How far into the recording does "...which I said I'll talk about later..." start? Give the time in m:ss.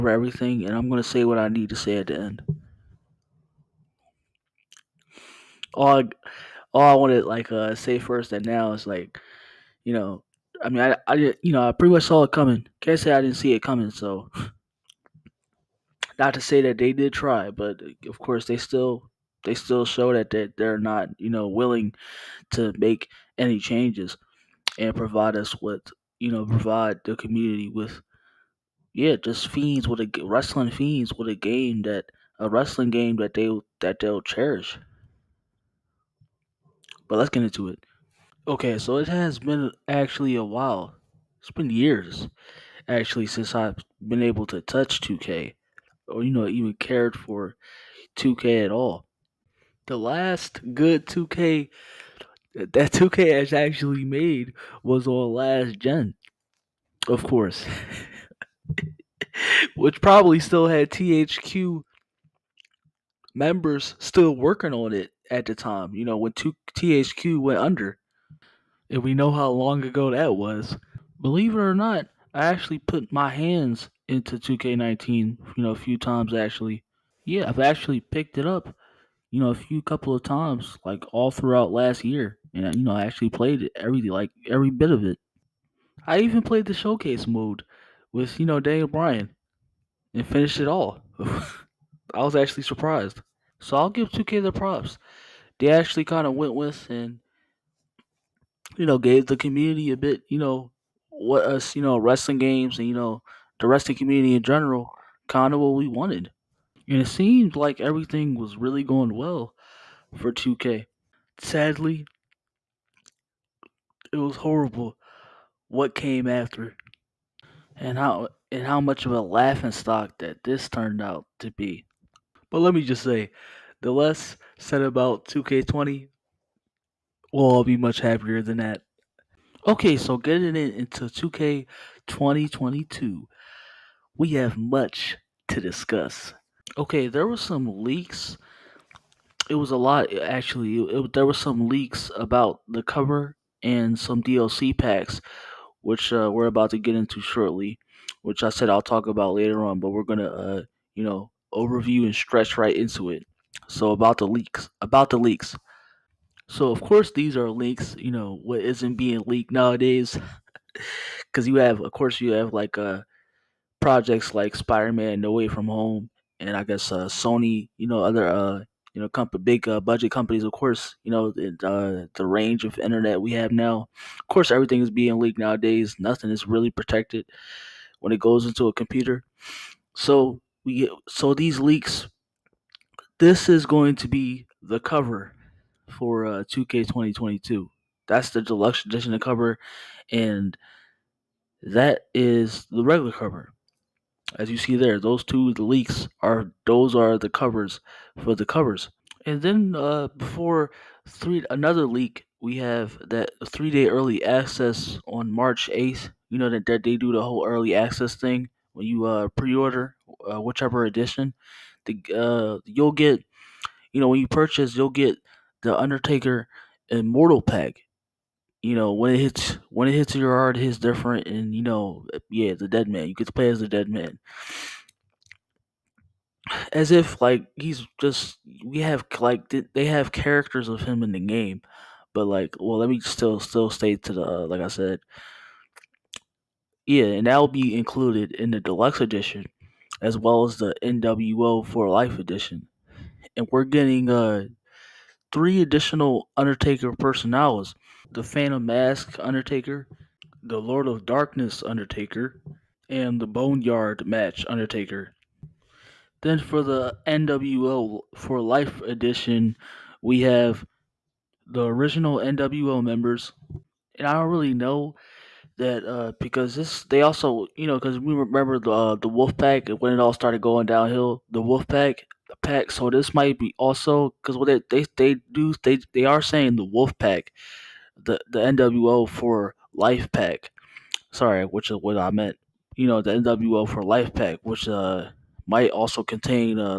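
2:28.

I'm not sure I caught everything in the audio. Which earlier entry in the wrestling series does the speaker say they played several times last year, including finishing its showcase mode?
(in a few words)
2K19.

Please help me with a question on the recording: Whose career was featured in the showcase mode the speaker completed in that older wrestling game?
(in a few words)
Daniel Bryan.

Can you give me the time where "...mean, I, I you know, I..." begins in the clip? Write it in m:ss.
0:10.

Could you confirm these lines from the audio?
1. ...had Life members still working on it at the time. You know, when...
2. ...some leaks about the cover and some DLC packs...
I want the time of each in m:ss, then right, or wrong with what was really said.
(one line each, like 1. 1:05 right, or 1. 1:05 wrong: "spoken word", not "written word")
1. 1:00 wrong: "THQ", not "Life"
2. 2:21 right.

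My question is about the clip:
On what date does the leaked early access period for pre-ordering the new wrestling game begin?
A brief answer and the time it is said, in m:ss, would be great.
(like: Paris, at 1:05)
March 8, at 3:25.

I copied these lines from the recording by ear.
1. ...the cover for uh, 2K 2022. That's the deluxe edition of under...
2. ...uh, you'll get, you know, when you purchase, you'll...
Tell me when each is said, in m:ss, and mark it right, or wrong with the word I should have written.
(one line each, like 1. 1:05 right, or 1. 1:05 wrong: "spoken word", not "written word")
1. 3:04 wrong: "cover", not "under"
2. 3:32 right.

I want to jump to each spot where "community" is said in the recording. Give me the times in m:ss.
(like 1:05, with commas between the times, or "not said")
0:27, 1:39, 1:43.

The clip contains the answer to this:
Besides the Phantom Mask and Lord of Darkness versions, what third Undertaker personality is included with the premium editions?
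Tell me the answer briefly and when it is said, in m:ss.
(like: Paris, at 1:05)
Boneyard Match Undertaker, at 4:13.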